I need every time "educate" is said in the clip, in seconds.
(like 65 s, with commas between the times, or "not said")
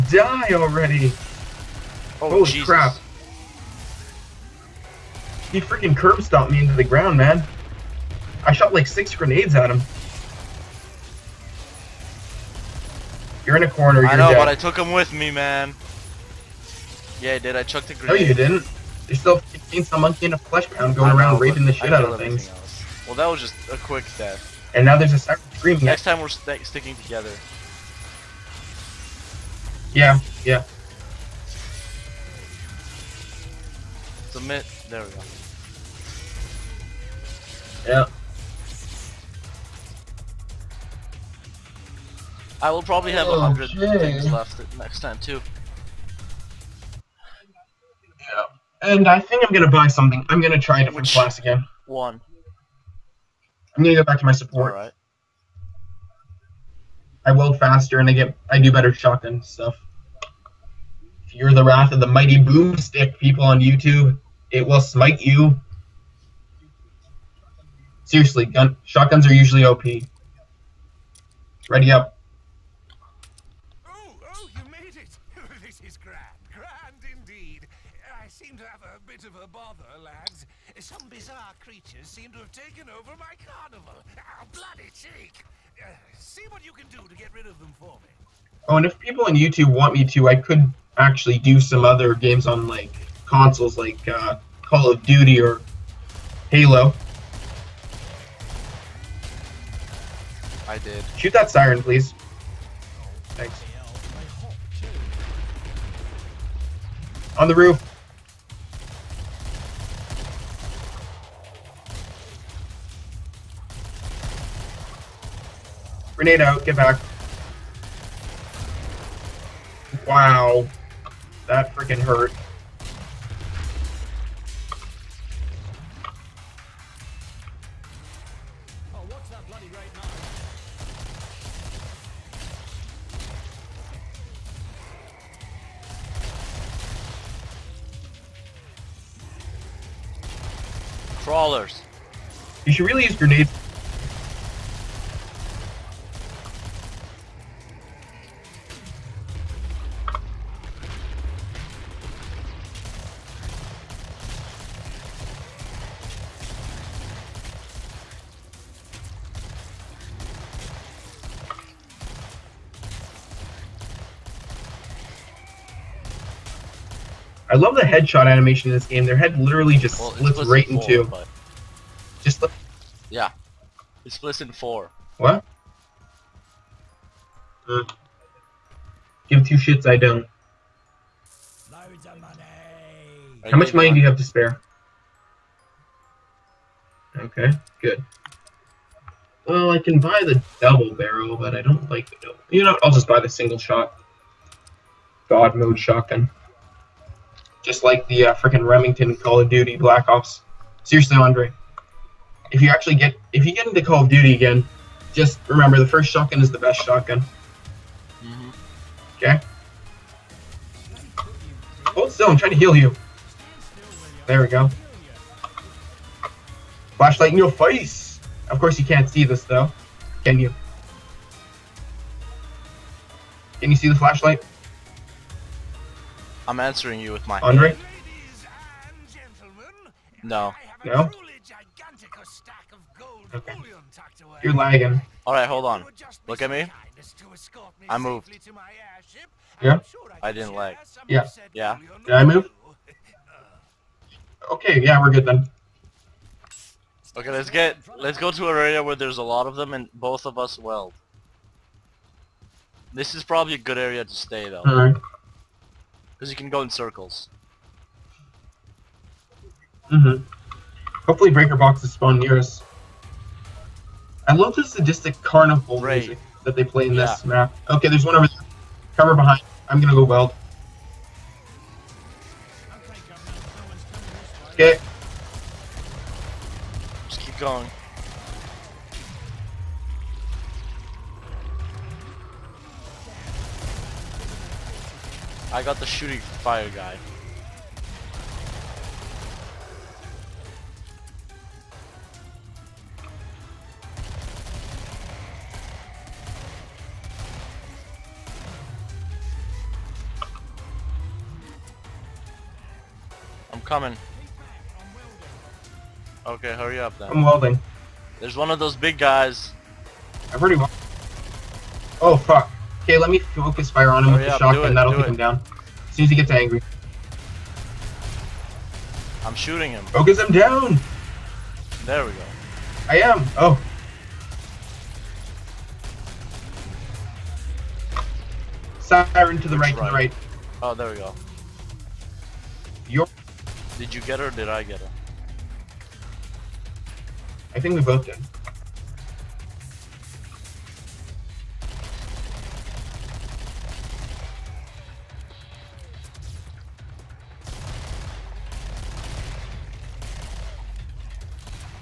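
not said.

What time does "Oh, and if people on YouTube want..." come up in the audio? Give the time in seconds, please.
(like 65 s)
88 s.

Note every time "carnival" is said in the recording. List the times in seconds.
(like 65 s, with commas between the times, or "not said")
83 s, 265 s.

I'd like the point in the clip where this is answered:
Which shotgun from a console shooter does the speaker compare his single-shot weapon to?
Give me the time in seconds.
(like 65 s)
198 s.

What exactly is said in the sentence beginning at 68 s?
Seriously, gun shotguns are usually OP.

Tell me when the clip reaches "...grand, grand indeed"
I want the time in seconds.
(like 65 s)
75 s.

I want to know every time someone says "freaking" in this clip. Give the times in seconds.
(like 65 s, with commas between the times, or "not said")
5 s, 121 s, 198 s.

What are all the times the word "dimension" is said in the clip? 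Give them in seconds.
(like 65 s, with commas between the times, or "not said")
not said.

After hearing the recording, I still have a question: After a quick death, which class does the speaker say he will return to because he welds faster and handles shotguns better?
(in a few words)
Support.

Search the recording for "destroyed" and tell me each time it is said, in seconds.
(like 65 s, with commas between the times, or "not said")
not said.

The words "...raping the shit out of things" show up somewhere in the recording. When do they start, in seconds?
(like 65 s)
21 s.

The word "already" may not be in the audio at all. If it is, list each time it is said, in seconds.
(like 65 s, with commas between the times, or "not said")
0 s, 310 s.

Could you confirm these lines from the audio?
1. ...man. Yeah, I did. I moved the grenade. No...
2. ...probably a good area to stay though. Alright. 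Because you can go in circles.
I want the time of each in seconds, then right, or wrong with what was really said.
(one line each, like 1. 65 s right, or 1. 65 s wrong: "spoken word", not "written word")
1. 15 s wrong: "chucked", not "moved"
2. 253 s right.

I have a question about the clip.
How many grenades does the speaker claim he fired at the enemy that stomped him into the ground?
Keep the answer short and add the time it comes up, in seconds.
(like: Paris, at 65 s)
6, at 8 s.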